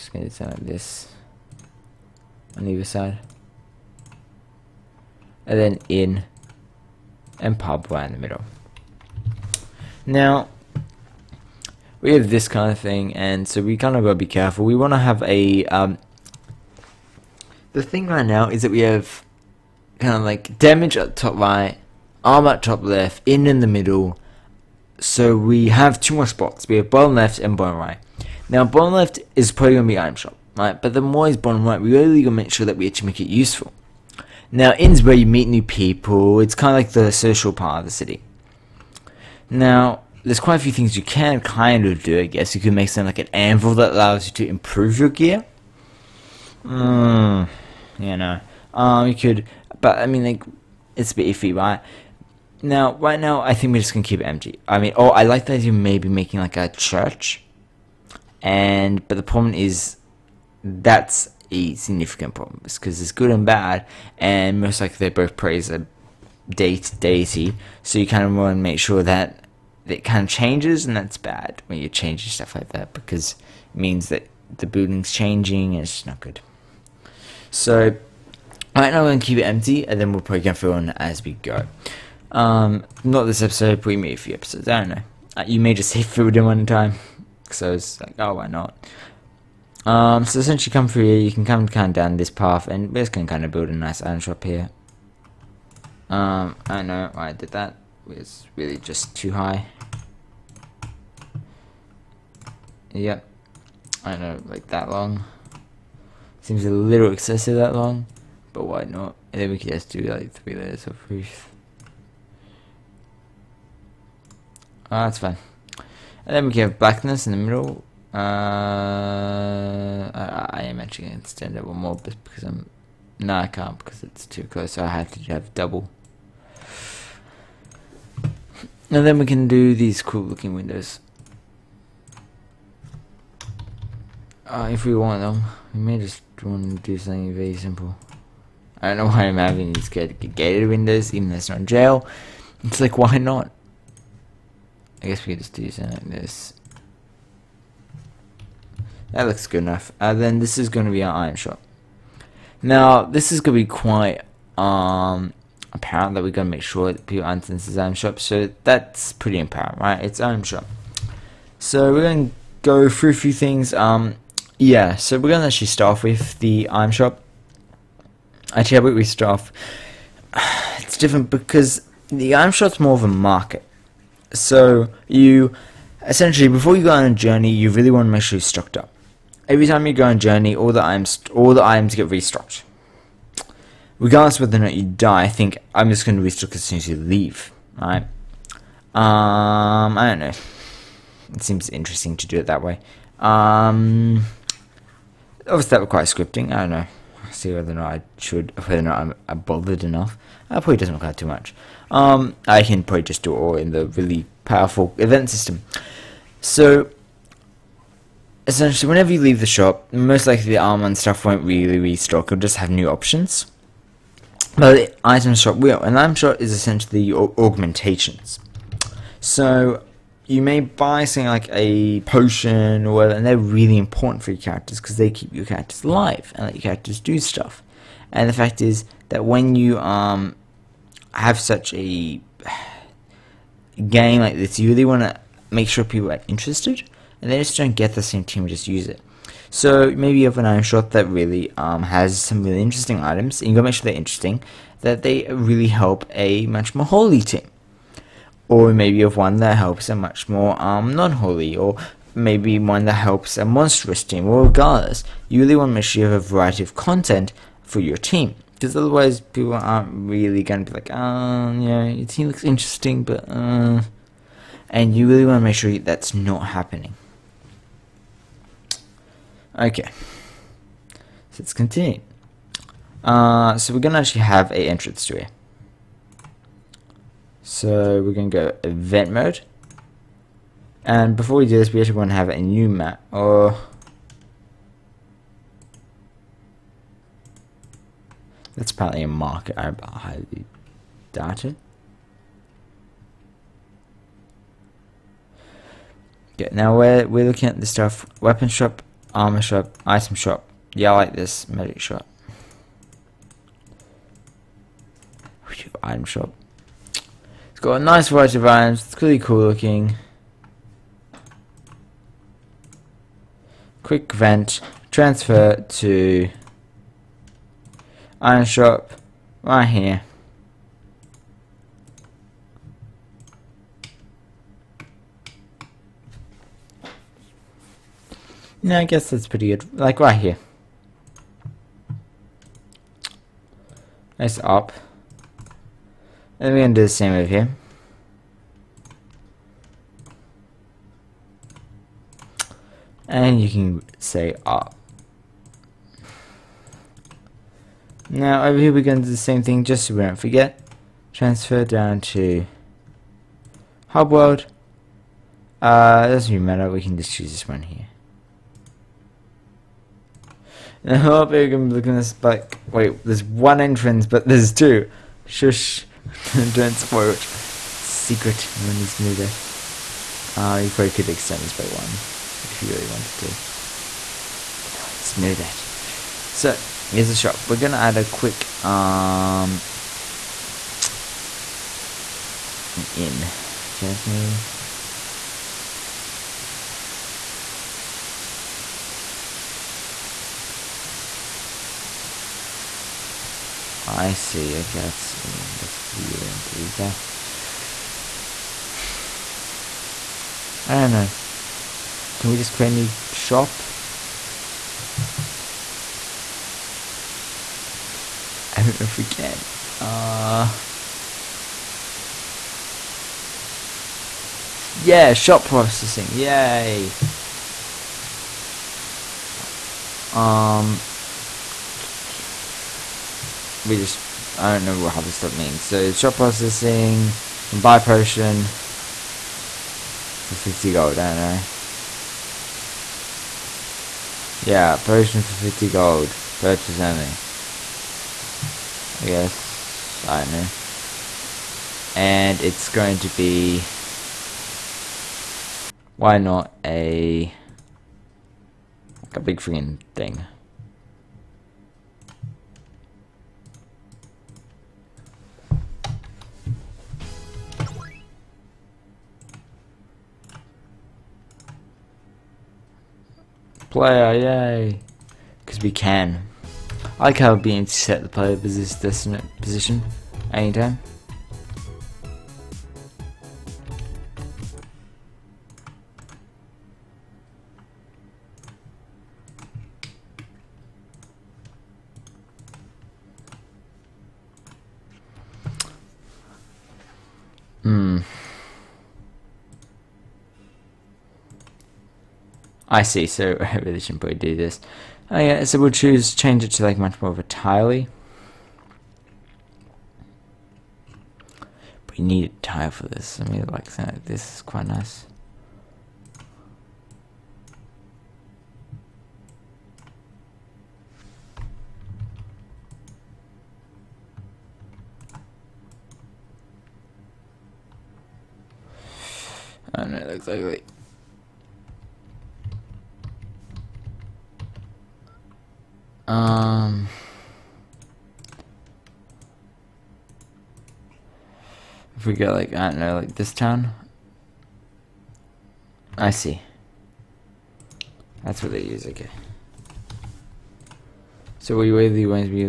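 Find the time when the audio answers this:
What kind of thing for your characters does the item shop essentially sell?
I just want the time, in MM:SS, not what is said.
03:37.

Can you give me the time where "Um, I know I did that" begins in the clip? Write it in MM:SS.
01:36.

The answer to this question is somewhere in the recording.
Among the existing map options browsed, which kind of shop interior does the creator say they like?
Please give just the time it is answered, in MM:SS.
05:01.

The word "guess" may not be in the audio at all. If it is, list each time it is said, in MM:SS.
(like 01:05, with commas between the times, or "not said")
00:42, 02:25, 05:28, 06:23, 07:19.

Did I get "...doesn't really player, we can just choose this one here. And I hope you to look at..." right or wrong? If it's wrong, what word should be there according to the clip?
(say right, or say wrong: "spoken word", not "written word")
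wrong: "matter", not "player".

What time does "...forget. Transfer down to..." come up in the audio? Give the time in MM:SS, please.
05:50.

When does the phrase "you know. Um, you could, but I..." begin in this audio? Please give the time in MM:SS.
00:47.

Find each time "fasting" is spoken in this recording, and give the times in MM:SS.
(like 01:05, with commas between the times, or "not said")
not said.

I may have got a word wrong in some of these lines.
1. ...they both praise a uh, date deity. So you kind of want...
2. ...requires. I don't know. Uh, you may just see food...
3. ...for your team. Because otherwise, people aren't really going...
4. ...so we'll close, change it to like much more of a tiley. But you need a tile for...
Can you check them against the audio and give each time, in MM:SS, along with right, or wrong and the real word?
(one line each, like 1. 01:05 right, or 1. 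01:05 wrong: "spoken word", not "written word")
1. 01:04 right
2. 01:24 wrong: "episodes", not "requires"
3. 04:17 right
4. 08:15 wrong: "choose", not "close".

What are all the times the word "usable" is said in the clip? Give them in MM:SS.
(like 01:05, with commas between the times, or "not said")
not said.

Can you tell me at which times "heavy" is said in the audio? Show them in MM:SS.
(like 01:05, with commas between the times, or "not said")
not said.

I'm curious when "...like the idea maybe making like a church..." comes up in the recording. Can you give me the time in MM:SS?
00:55.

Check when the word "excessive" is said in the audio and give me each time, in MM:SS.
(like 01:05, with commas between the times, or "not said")
01:47.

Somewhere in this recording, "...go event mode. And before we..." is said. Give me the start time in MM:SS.
04:38.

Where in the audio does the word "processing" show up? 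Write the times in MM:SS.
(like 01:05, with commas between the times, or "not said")
06:55, 07:06.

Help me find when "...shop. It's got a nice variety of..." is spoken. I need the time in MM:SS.
05:06.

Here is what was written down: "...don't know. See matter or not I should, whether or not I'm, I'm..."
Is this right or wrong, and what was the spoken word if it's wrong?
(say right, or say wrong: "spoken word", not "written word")
wrong: "whether", not "matter".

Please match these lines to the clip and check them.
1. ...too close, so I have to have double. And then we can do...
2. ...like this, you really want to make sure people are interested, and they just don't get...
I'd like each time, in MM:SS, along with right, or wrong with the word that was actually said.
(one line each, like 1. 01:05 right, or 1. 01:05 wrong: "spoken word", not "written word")
1. 02:04 right
2. 03:54 right.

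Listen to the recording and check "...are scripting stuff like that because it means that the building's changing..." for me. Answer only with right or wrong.
wrong.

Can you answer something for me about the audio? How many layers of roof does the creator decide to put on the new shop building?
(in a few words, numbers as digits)
3.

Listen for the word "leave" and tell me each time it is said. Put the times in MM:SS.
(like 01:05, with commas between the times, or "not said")
03:06, 03:29.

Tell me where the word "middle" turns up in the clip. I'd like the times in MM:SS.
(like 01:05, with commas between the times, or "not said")
00:08, 00:23, 01:57.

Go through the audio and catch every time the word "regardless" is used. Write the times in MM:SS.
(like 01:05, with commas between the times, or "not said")
03:04, 04:14.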